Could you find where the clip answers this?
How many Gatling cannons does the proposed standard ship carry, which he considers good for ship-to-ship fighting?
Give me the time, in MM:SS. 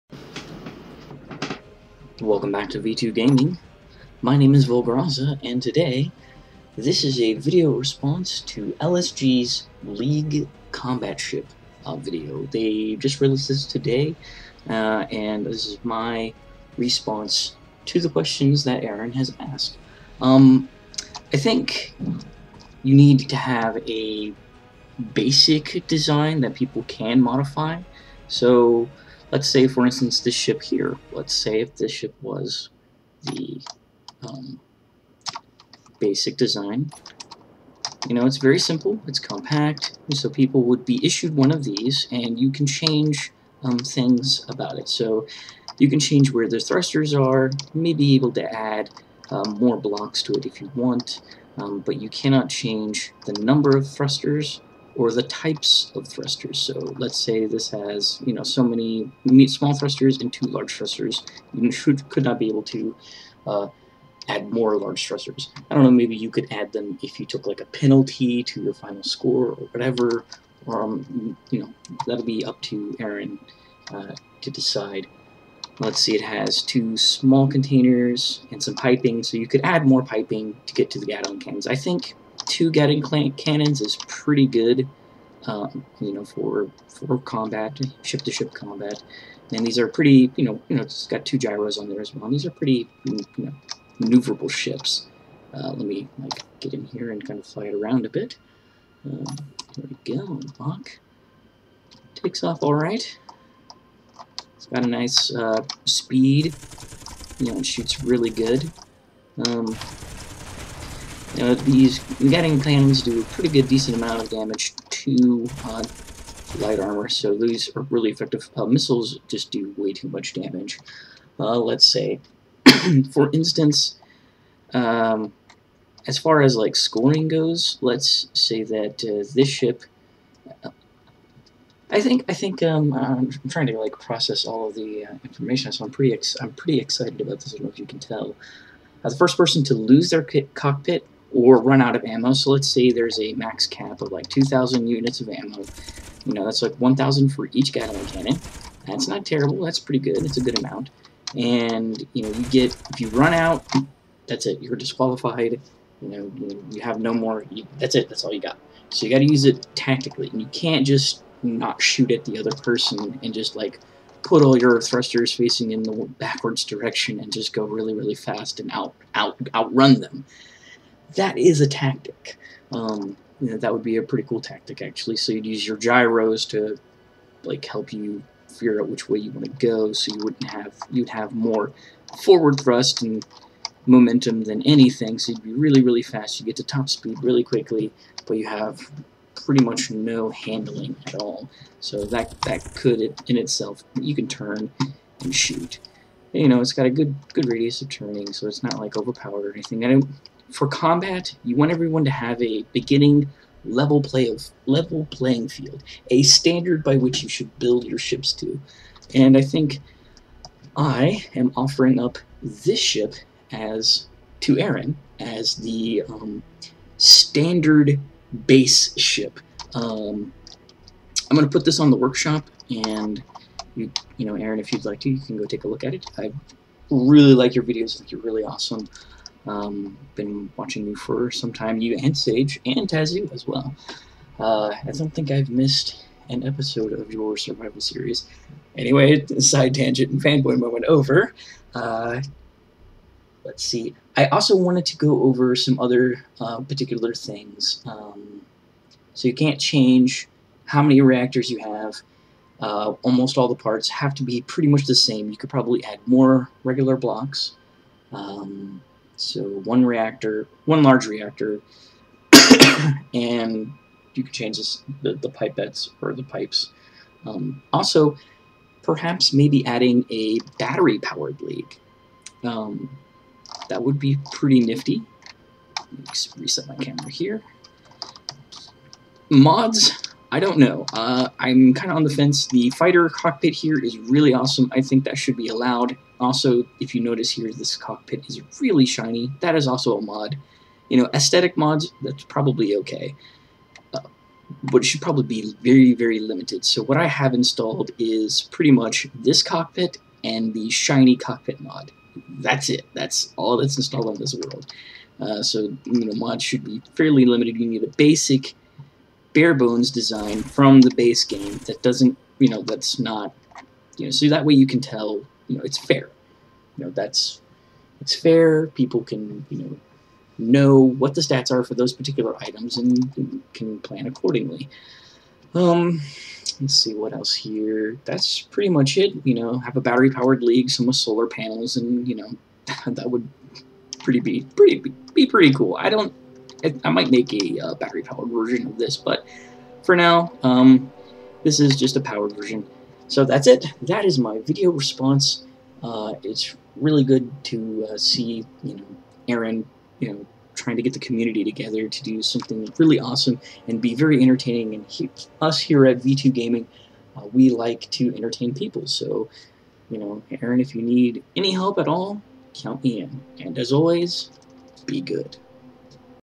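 01:22.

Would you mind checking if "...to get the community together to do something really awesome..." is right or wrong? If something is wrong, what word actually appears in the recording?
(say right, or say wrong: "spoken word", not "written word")
right.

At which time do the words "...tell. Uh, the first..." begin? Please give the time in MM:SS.
02:17.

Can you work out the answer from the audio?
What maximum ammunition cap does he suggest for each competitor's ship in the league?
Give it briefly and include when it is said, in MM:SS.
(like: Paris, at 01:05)
2,000 units, at 02:24.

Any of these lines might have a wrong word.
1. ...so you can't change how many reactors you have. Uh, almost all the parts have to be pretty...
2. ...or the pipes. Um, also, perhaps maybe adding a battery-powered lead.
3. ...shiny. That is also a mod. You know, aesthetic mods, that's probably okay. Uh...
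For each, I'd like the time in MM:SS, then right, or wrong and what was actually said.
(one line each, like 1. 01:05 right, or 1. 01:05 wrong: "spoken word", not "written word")
1. 04:09 right
2. 04:26 right
3. 04:48 right.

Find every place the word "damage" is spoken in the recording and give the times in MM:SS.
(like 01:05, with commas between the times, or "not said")
01:54, 02:00.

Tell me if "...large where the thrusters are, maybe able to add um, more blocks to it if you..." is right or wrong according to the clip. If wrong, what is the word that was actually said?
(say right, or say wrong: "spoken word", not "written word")
wrong: "change", not "large".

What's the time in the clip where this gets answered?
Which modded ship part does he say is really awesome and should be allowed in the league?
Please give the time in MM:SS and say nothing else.
04:42.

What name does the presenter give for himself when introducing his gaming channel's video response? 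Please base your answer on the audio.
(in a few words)
Volgraza.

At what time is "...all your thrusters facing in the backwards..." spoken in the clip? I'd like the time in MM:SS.
02:44.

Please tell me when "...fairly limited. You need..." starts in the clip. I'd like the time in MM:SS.
05:06.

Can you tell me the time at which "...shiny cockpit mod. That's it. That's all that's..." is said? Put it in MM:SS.
05:00.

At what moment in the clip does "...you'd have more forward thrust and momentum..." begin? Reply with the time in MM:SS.
03:00.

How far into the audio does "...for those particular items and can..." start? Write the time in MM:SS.
05:21.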